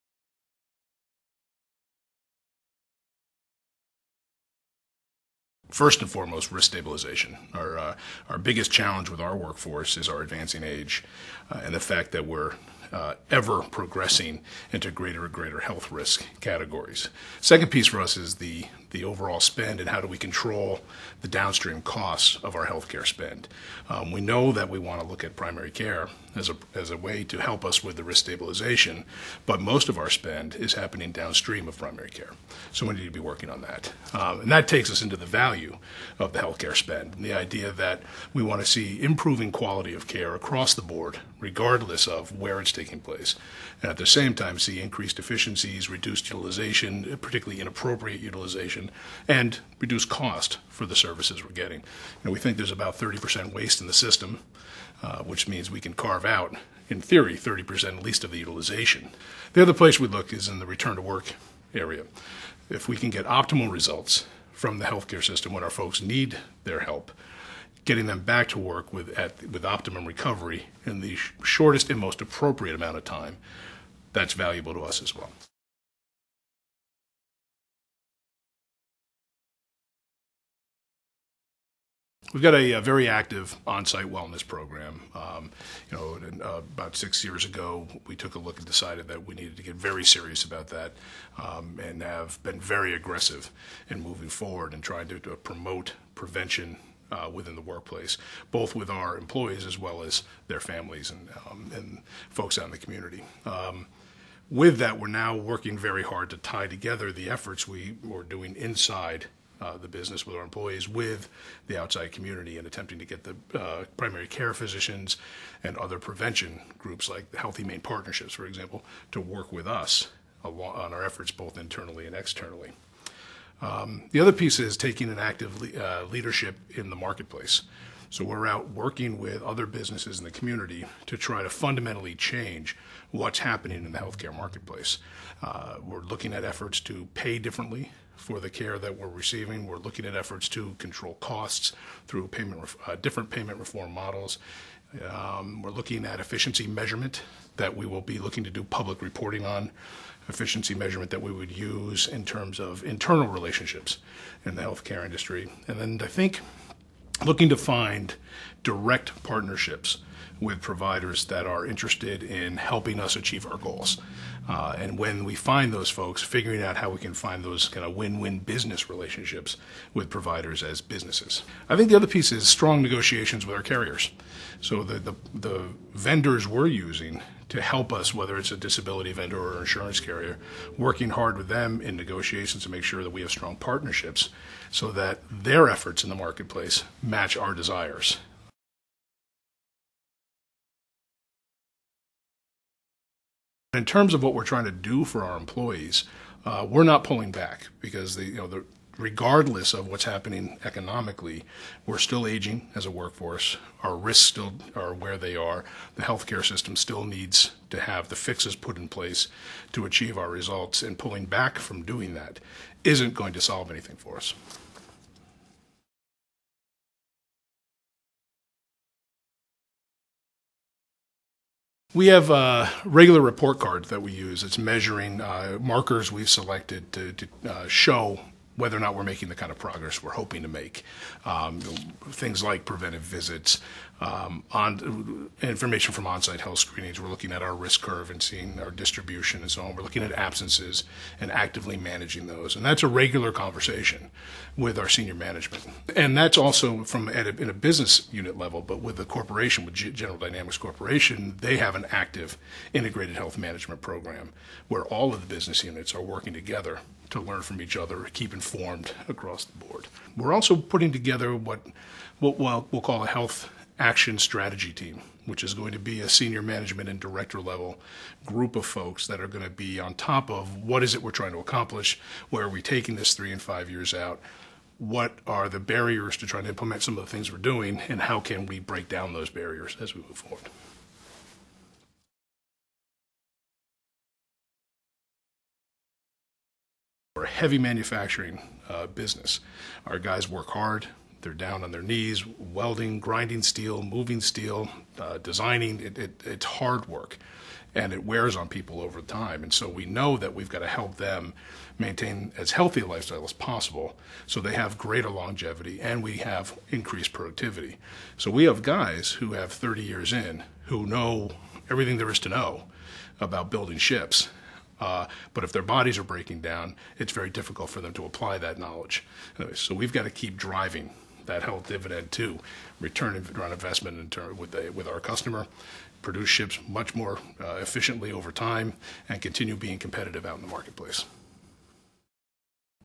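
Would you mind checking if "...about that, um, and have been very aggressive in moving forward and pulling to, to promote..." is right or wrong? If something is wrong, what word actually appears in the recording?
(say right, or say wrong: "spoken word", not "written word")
wrong: "trying", not "pulling".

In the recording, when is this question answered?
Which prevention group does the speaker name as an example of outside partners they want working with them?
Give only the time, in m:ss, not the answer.
1:57.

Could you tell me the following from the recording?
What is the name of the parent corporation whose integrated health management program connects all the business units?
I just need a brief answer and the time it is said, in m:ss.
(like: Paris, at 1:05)
General Dynamics, at 4:09.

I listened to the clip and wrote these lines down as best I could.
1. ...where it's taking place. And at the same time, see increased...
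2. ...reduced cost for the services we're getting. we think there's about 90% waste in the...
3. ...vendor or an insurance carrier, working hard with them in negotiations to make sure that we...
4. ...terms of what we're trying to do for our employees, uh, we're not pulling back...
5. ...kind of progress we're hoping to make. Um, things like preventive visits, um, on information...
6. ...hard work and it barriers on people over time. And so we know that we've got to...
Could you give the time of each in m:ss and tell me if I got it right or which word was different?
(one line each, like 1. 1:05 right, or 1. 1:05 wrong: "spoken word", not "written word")
1. 0:42 right
2. 0:49 wrong: "30", not "90"
3. 2:59 right
4. 3:13 right
5. 3:49 right
6. 4:56 wrong: "wears", not "barriers".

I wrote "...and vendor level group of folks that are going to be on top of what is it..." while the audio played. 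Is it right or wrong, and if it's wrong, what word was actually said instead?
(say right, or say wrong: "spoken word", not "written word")
wrong: "director", not "vendor".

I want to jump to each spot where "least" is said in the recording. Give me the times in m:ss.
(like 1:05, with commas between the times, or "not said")
0:58.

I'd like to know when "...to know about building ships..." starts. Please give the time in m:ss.
5:12.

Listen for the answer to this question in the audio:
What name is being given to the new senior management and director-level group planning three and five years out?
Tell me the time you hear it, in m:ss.
4:23.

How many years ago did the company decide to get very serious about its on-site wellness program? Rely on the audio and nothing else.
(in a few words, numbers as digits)
6.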